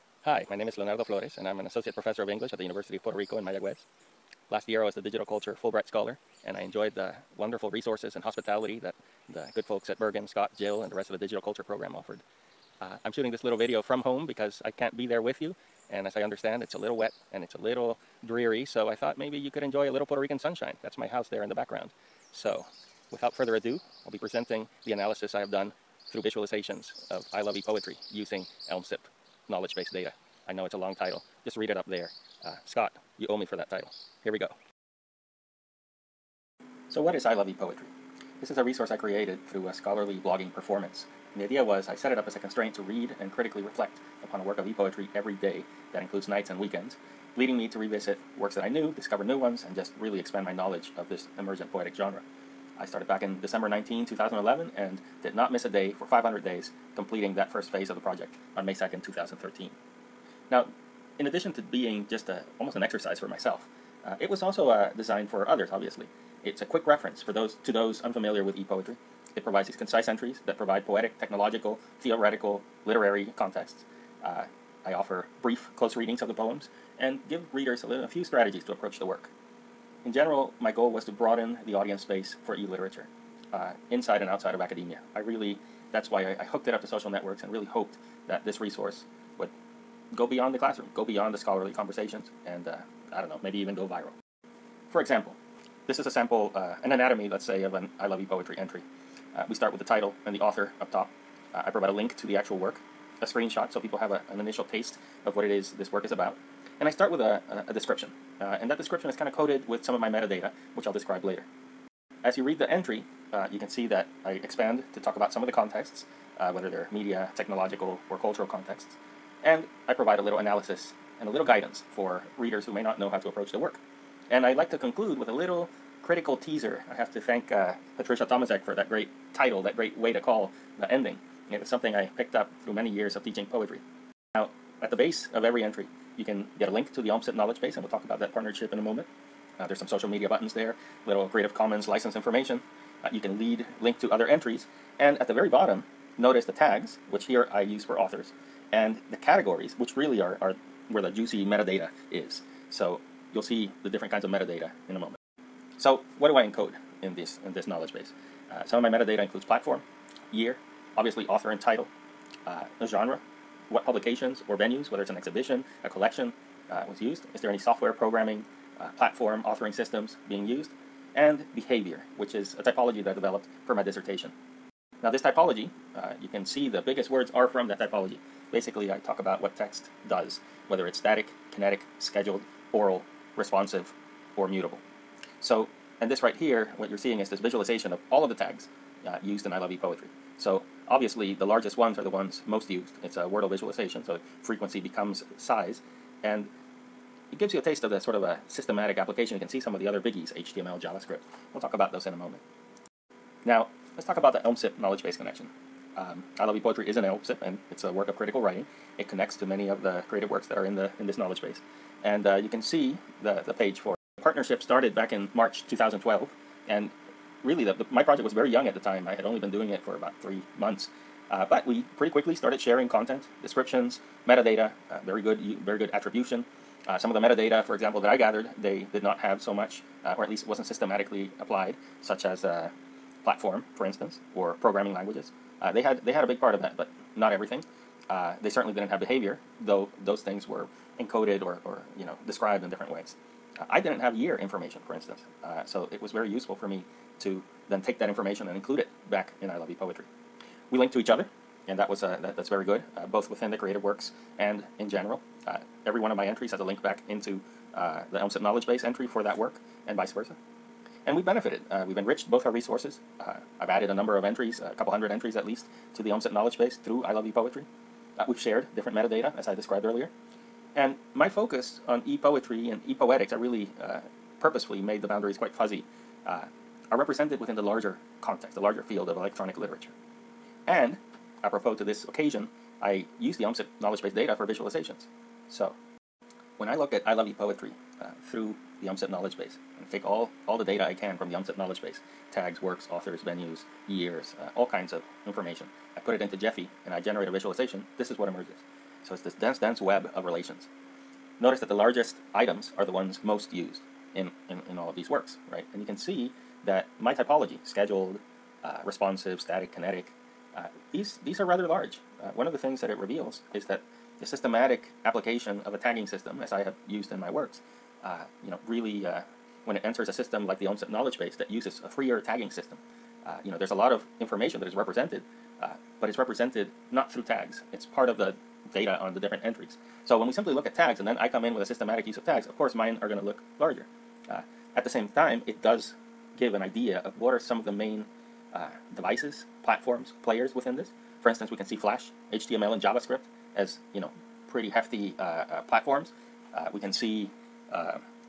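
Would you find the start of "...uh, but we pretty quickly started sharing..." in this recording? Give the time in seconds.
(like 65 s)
221 s.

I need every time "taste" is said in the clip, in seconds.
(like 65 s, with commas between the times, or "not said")
104 s, 197 s.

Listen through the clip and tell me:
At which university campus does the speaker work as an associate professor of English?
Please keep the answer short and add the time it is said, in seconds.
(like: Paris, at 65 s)
University of Puerto Rico in Mayagüez, at 2 s.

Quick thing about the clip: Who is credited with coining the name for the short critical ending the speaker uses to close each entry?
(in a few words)
Patricia Tomaszek.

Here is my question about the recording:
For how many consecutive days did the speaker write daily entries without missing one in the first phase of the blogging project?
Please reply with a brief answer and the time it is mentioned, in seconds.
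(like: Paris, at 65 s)
500, at 56 s.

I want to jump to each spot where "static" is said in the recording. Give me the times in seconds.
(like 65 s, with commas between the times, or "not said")
180 s, 309 s.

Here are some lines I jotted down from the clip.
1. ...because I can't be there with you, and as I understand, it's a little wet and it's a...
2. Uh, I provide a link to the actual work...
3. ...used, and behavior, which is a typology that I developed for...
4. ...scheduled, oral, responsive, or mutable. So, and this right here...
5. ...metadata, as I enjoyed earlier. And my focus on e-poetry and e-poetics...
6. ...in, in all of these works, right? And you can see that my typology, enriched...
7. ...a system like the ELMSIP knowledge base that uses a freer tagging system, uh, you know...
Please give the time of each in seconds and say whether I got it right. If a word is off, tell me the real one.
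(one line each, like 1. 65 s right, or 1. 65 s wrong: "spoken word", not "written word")
1. 14 s right
2. 101 s right
3. 170 s right
4. 181 s right
5. 268 s wrong: "described", not "enjoyed"
6. 304 s wrong: "scheduled", not "enriched"
7. 320 s right.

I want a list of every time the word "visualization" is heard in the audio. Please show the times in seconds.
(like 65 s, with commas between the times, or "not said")
26 s, 187 s, 193 s, 284 s, 297 s.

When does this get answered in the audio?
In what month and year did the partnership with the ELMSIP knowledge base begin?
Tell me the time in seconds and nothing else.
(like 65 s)
215 s.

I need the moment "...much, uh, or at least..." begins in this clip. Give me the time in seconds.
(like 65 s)
229 s.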